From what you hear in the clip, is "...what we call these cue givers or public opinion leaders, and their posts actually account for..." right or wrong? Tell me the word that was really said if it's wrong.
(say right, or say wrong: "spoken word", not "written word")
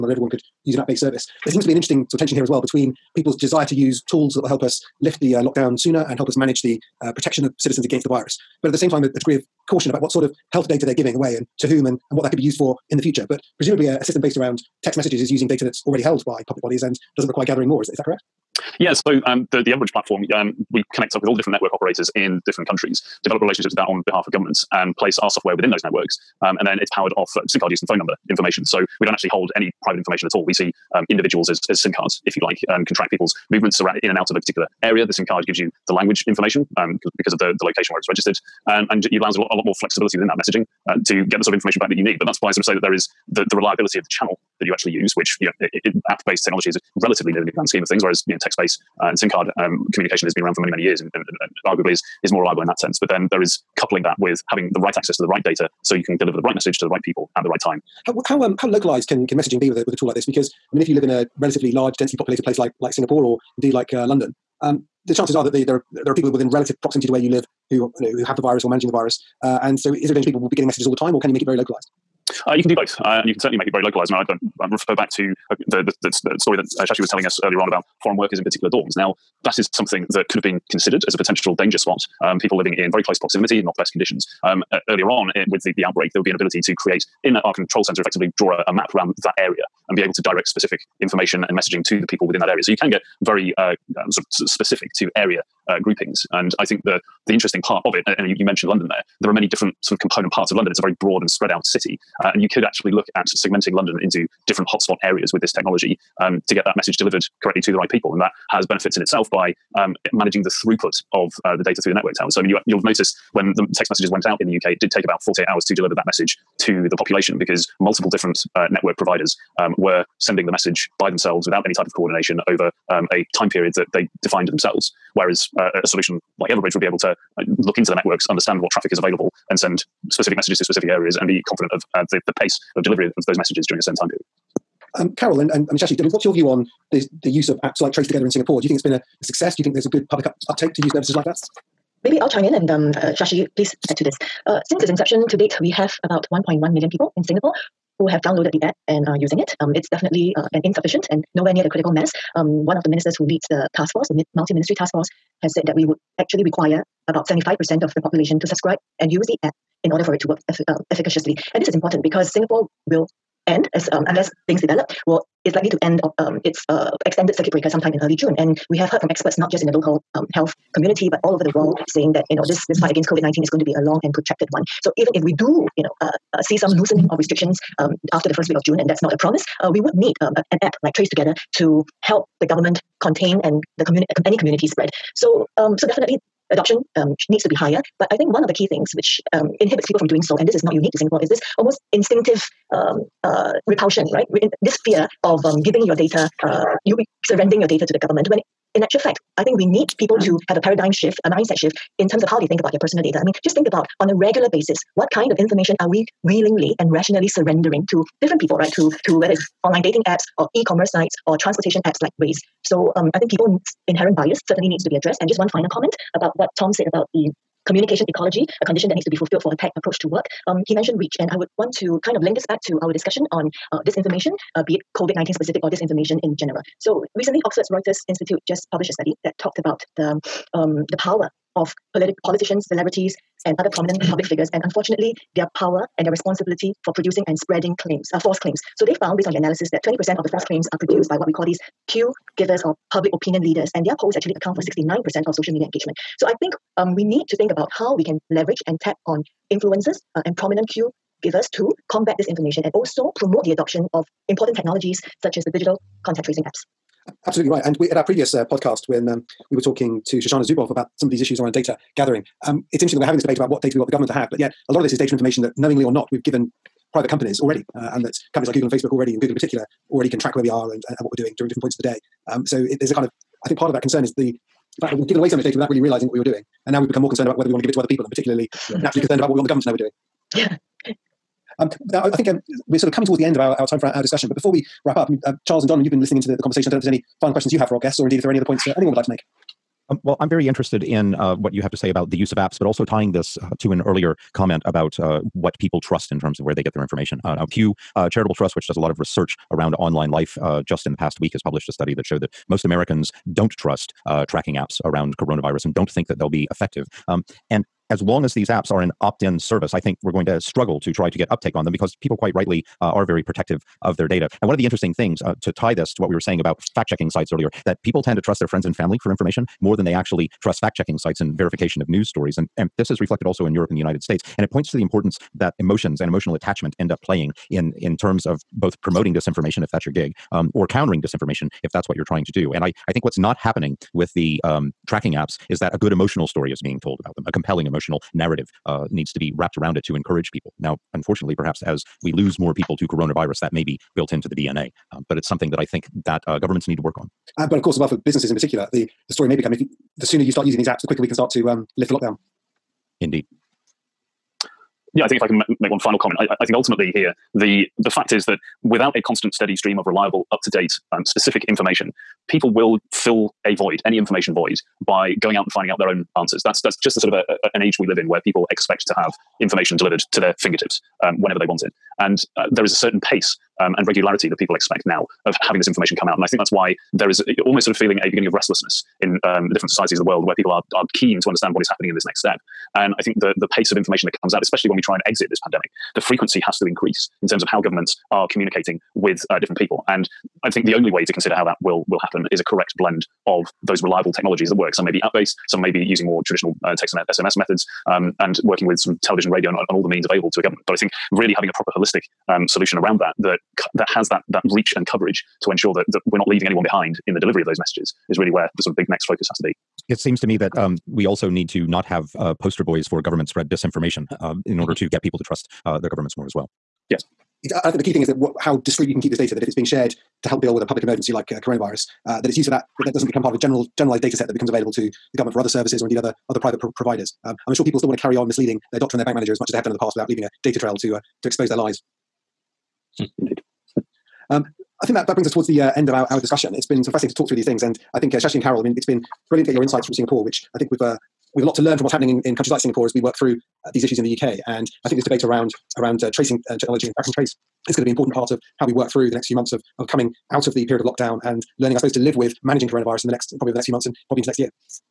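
right.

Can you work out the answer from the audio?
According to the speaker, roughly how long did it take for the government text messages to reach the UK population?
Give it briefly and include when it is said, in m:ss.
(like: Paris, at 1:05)
48 hours, at 1:55.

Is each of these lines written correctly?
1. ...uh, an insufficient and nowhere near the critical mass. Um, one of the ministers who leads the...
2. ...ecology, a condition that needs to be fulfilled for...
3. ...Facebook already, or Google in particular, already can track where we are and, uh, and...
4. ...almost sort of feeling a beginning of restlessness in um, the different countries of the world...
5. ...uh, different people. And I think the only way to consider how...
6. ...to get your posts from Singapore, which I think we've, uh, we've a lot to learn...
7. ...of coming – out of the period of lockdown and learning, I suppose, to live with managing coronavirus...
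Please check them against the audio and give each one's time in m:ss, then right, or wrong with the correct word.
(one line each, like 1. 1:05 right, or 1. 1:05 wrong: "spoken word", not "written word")
1. 2:30 right
2. 3:38 right
3. 4:28 right
4. 6:17 wrong: "societies", not "countries"
5. 6:29 right
6. 7:19 wrong: "insights", not "posts"
7. 7:29 right.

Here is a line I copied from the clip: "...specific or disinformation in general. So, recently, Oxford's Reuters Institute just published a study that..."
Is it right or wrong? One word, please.
right.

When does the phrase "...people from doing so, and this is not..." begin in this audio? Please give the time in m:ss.
3:09.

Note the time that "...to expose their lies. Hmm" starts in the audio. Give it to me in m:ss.
7:11.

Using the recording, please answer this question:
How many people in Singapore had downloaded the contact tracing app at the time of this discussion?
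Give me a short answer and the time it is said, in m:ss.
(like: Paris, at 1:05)
1.1 million, at 2:26.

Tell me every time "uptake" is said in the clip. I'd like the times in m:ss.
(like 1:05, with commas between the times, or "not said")
2:20, 5:11.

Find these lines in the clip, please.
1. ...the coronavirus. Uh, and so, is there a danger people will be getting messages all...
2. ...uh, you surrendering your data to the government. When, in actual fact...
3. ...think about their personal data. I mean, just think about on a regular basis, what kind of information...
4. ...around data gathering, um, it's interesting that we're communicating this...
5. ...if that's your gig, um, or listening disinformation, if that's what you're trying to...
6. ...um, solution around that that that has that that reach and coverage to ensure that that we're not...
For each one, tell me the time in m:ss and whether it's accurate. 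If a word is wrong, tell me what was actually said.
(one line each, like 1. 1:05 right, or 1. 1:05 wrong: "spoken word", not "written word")
1. 1:08 wrong: "virus", not "coronavirus"
2. 3:16 right
3. 3:22 right
4. 4:21 wrong: "having", not "communicating"
5. 5:29 wrong: "countering", not "listening"
6. 6:42 right.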